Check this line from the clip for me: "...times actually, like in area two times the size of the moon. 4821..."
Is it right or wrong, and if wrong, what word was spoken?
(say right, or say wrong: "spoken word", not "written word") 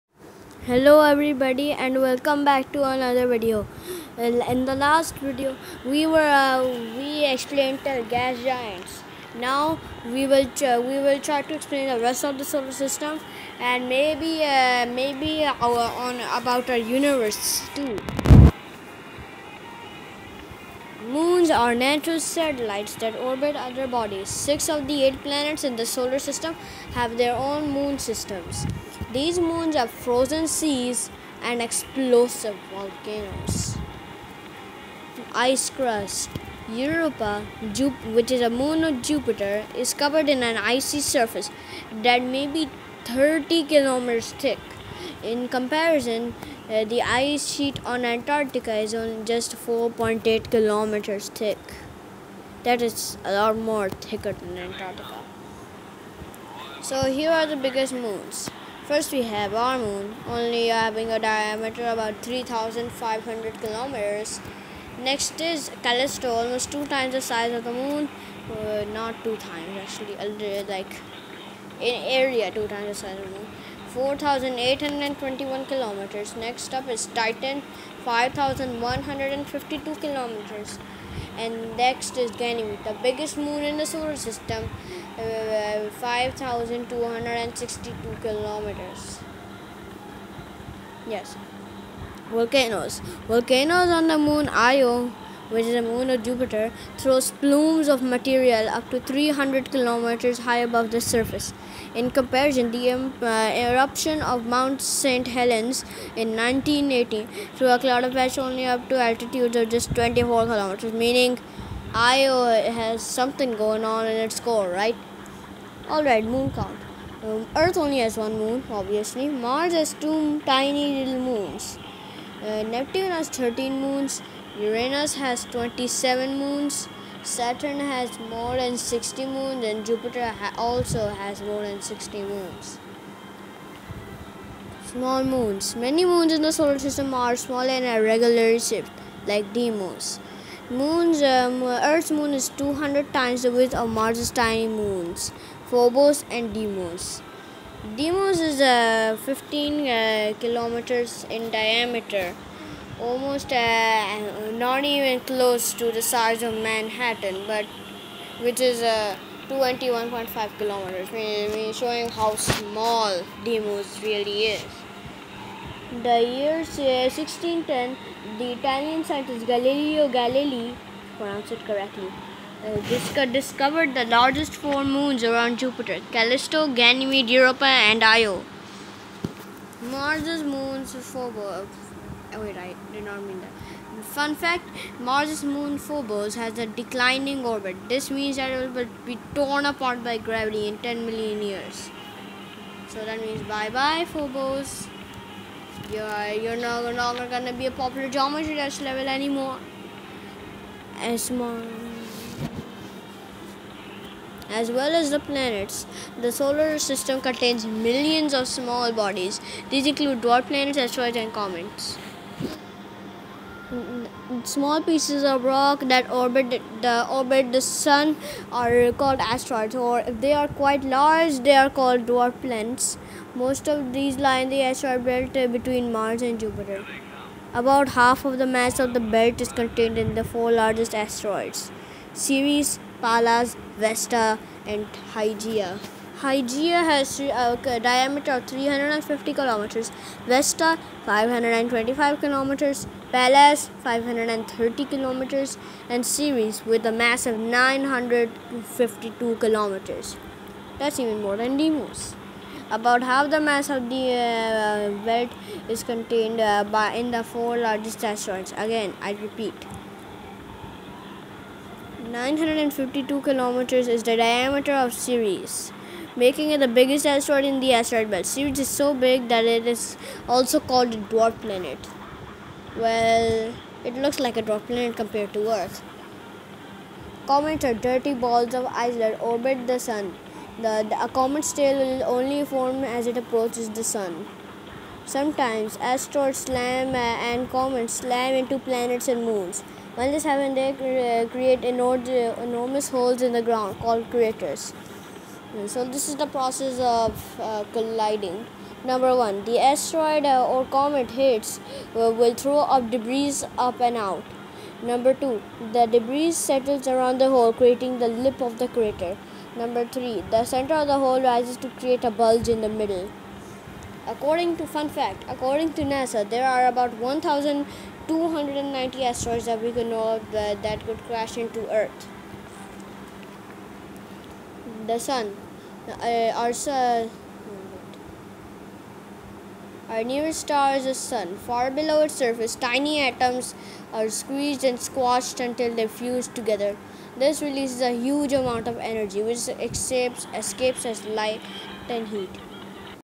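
right.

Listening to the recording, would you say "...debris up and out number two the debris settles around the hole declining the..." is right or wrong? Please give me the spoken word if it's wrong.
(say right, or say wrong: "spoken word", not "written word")
wrong: "creating", not "declining".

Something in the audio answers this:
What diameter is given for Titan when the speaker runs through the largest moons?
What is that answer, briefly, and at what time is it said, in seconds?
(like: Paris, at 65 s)
5152 kilometers, at 78 s.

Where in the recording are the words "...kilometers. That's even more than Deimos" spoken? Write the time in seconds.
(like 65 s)
249 s.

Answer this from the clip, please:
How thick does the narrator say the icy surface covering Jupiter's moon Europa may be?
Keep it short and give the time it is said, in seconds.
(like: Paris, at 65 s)
30 kilometers, at 43 s.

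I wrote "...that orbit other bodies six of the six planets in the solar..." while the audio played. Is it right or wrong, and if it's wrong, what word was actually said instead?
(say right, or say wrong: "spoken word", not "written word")
wrong: "eight", not "six".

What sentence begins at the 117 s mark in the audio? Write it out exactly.
Um, Earth only has one moon, obviously.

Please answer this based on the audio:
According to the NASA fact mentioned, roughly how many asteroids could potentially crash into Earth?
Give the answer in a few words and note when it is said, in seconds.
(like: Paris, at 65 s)
1290, at 317 s.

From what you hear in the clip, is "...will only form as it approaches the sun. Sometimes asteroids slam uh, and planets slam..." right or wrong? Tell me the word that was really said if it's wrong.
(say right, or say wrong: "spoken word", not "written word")
wrong: "comets", not "planets".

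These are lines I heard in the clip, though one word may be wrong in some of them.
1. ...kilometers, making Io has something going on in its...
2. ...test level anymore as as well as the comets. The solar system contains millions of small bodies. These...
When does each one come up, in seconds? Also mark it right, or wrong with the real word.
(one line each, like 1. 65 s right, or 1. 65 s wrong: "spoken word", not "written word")
1. 110 s wrong: "meaning", not "making"
2. 198 s wrong: "planets", not "comets".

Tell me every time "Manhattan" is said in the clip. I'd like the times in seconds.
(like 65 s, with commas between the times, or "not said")
156 s.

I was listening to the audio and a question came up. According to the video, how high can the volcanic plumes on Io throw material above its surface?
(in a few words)
300 kilometers.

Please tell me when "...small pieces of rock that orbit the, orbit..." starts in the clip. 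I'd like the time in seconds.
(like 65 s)
214 s.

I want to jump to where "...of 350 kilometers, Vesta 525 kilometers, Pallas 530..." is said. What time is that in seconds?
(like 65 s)
238 s.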